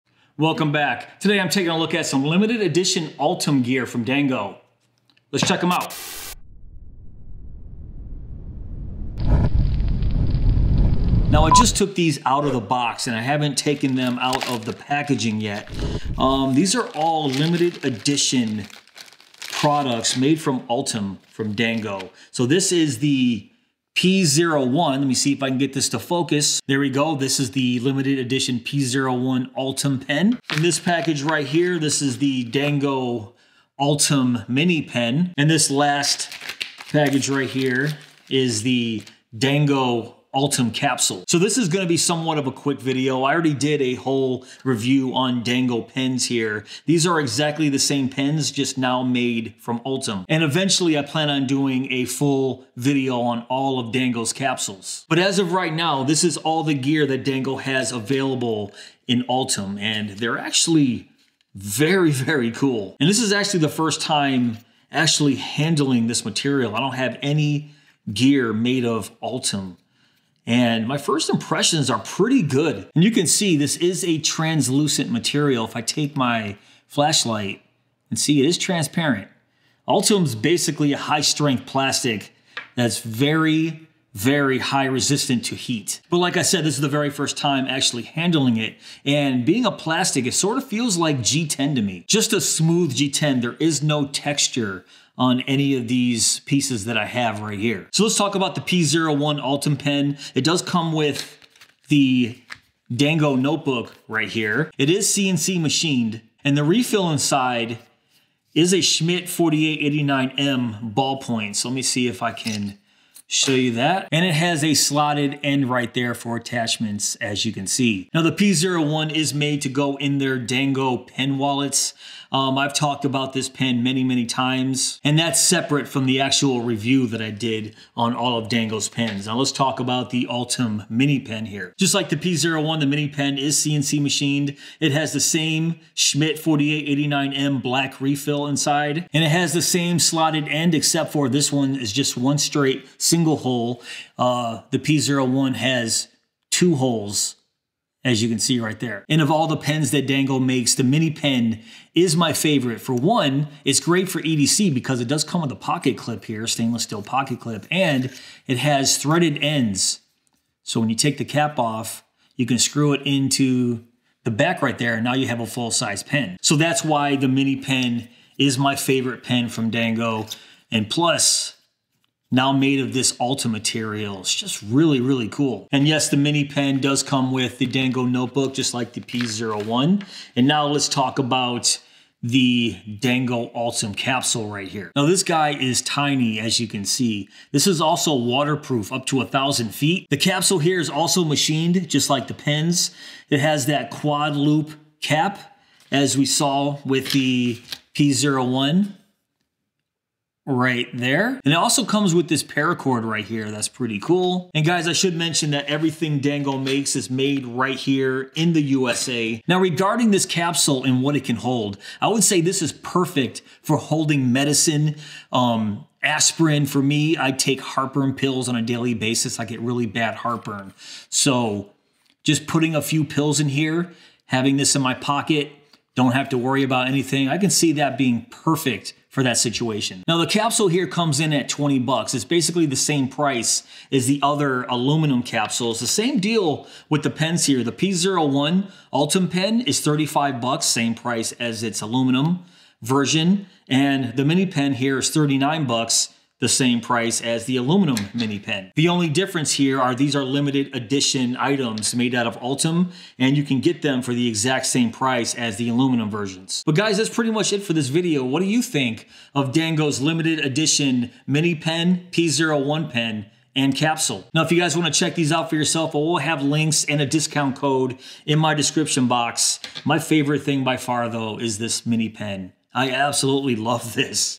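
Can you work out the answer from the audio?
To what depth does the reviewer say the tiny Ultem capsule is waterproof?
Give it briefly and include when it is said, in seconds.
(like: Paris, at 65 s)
1000 feet, at 189 s.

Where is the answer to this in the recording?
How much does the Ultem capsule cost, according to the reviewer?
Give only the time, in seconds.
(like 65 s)
231 s.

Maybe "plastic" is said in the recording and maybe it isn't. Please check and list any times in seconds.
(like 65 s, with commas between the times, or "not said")
81 s, 89 s.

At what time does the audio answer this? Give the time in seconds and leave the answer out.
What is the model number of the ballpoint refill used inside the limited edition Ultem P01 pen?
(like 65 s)
108 s.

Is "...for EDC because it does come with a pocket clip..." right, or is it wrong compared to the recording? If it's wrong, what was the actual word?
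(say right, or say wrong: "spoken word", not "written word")
right.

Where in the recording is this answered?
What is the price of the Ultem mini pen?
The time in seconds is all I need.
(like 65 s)
245 s.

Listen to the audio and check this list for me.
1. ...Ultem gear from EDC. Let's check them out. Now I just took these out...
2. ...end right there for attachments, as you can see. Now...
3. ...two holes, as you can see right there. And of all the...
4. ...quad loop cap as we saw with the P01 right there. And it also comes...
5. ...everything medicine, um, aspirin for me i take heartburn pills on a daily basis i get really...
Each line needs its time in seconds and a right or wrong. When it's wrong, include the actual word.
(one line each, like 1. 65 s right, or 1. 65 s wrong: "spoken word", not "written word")
1. 3 s wrong: "Dango", not "EDC"
2. 115 s right
3. 146 s right
4. 193 s right
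5. 213 s wrong: "holding", not "everything".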